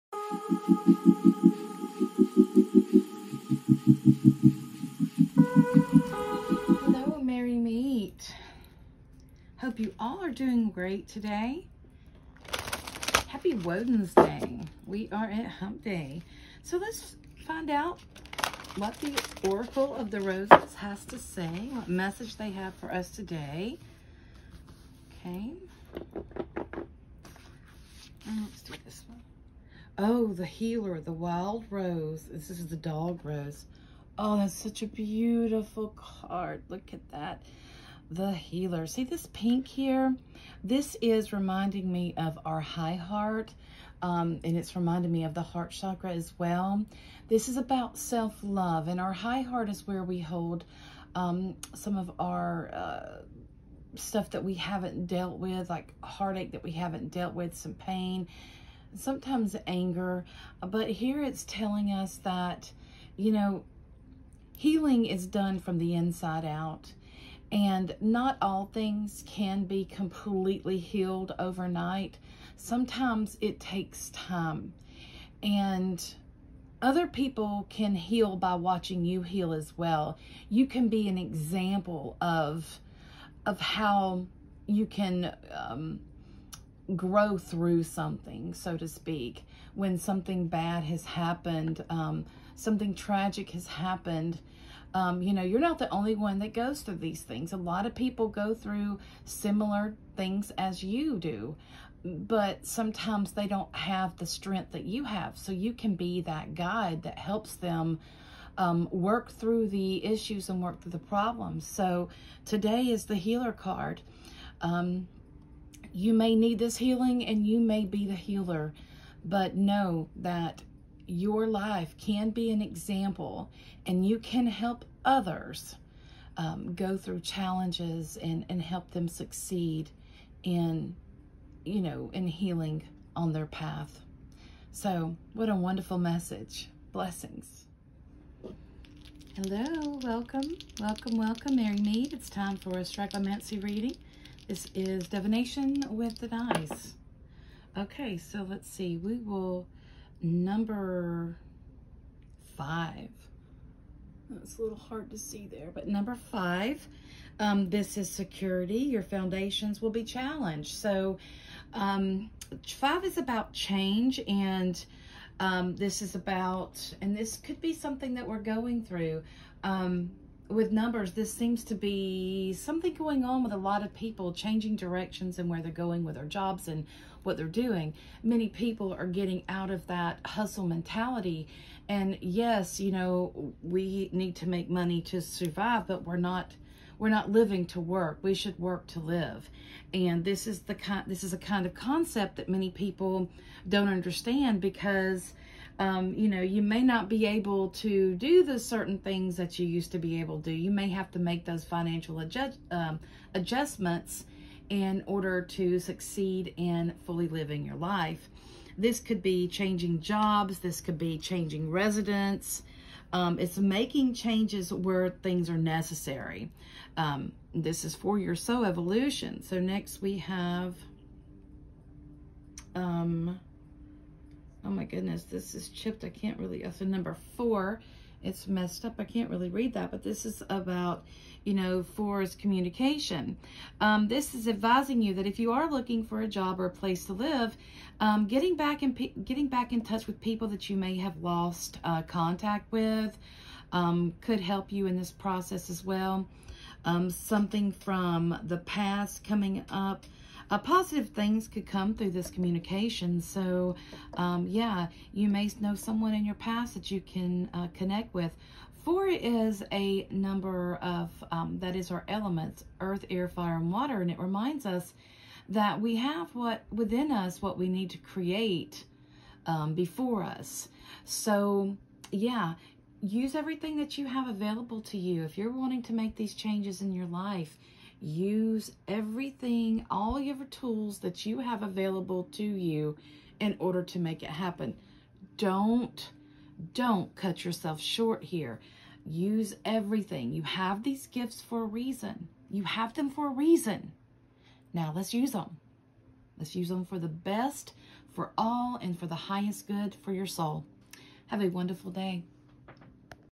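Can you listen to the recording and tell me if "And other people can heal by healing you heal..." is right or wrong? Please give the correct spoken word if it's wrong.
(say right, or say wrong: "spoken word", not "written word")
wrong: "watching", not "healing".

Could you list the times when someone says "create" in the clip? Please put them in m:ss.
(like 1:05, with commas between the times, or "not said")
4:27.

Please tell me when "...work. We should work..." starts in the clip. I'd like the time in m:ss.
3:07.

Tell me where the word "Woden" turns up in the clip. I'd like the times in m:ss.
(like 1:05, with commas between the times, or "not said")
0:13.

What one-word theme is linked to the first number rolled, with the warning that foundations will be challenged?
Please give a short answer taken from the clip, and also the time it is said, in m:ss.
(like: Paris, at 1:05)
security, at 2:38.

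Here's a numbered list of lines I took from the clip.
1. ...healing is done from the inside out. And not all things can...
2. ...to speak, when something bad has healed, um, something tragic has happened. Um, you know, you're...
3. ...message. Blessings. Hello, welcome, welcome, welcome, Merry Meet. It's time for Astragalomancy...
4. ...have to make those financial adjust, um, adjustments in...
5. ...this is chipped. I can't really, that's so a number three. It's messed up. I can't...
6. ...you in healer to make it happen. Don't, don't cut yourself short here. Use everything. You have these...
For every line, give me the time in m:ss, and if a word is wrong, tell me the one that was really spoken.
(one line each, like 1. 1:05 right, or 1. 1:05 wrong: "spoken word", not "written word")
1. 1:04 right
2. 1:28 wrong: "happened", not "healed"
3. 2:15 right
4. 3:20 right
5. 3:45 wrong: "four", not "three"
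6. 4:42 wrong: "order", not "healer".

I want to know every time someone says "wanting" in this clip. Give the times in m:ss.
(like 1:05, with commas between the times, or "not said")
4:35.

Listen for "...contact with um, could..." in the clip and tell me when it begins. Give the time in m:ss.
4:02.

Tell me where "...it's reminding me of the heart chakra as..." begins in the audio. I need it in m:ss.
0:44.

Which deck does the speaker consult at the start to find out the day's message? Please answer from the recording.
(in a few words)
Oracle of the Roses.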